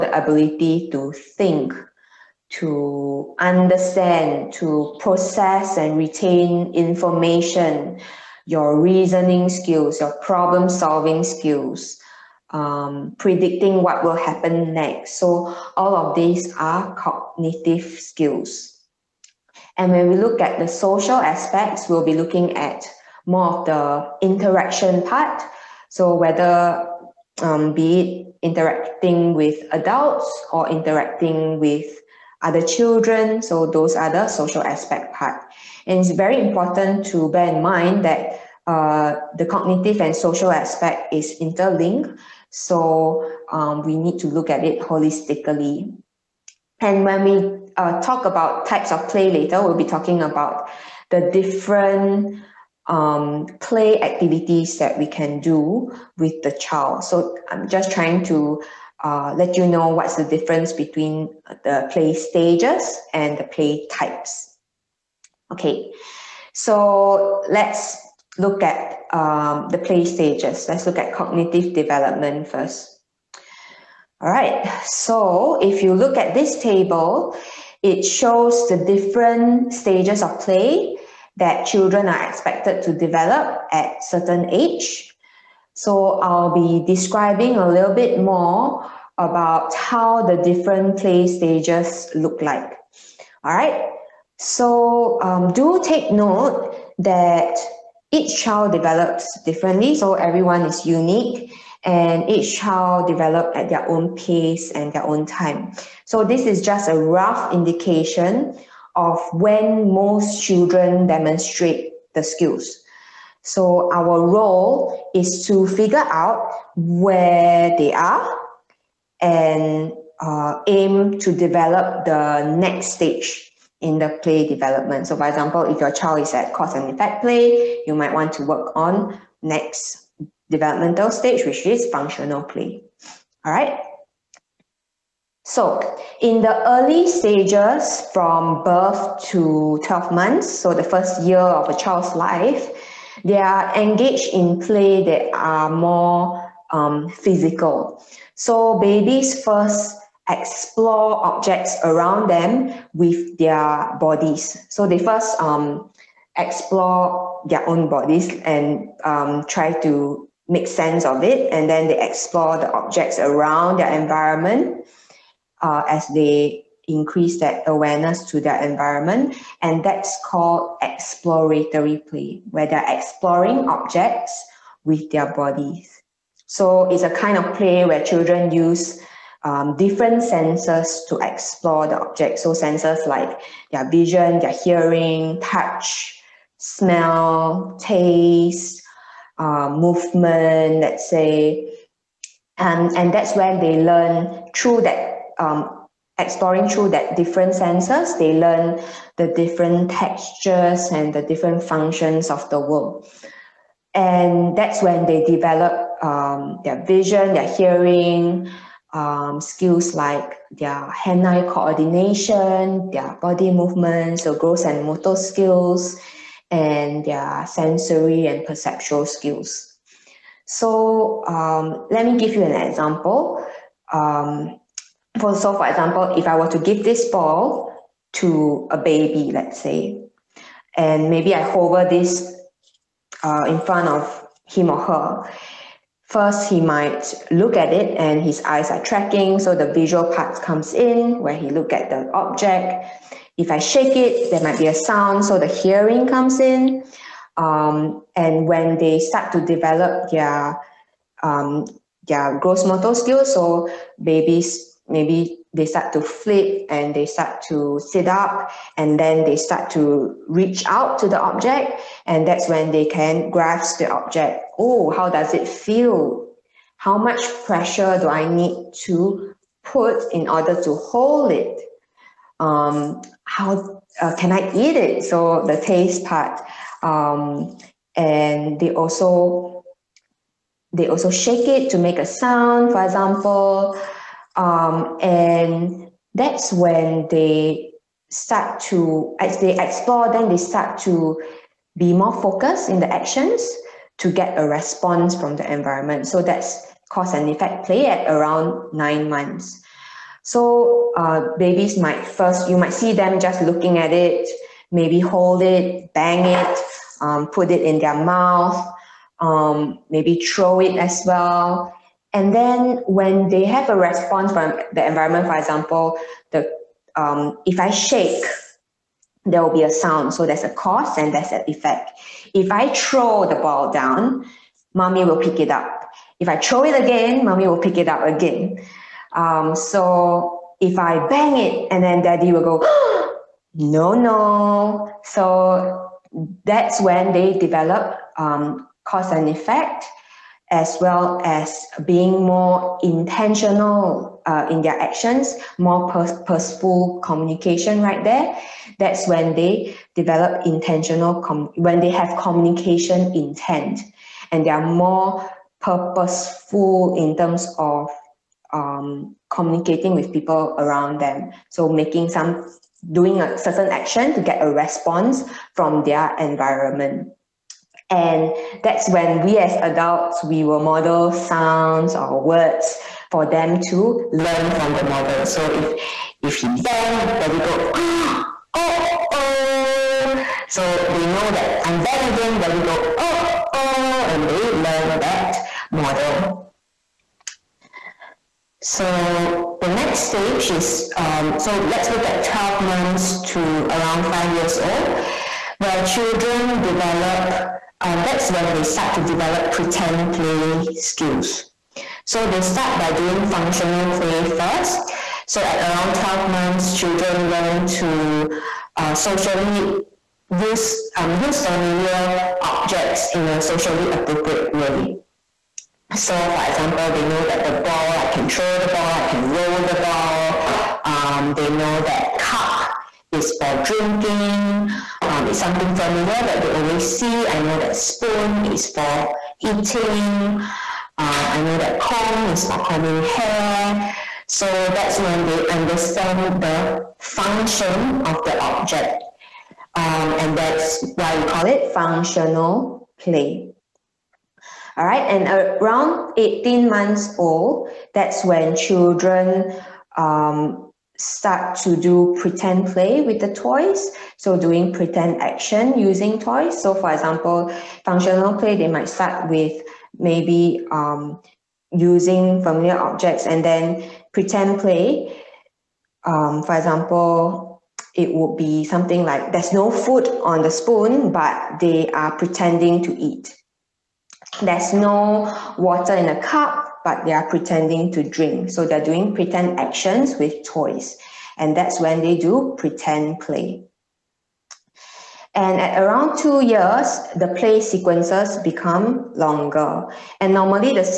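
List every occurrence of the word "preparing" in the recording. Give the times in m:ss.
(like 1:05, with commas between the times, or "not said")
not said.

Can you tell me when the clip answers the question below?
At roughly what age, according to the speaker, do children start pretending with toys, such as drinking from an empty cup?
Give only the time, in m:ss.
7:26.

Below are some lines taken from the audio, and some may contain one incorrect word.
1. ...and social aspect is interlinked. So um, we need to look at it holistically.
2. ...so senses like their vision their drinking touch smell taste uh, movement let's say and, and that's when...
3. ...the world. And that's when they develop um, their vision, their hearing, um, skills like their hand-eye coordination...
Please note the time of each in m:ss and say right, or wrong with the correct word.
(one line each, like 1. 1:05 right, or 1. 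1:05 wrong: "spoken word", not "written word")
1. 0:40 right
2. 3:02 wrong: "hearing", not "drinking"
3. 3:22 right.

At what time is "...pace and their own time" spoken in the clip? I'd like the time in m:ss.
1:44.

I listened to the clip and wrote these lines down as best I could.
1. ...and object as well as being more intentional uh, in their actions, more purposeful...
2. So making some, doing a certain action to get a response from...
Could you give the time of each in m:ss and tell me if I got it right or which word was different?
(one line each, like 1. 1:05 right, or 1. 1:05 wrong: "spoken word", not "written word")
1. 5:39 wrong: "effect", not "object"
2. 6:01 right.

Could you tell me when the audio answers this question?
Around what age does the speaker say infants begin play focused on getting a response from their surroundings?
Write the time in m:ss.
4:58.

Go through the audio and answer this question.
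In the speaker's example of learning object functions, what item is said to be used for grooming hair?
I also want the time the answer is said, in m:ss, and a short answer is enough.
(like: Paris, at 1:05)
Comb, at 7:11.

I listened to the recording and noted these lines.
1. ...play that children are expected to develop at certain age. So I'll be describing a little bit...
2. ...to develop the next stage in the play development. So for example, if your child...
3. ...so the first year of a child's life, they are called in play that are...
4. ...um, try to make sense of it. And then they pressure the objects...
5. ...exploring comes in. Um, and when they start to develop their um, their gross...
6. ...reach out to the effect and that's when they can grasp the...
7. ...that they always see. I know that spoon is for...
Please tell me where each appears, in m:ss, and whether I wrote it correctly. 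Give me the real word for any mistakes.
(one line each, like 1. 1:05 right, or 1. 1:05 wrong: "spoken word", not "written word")
1. 1:20 right
2. 2:01 right
3. 2:20 wrong: "engaged", not "called"
4. 2:39 wrong: "explore", not "pressure"
5. 4:05 wrong: "hearing", not "exploring"
6. 4:20 wrong: "object", not "effect"
7. 7:06 right.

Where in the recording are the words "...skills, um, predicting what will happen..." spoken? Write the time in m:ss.
0:11.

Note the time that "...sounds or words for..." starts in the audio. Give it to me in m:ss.
6:11.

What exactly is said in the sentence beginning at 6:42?
So they start by doing functional play first.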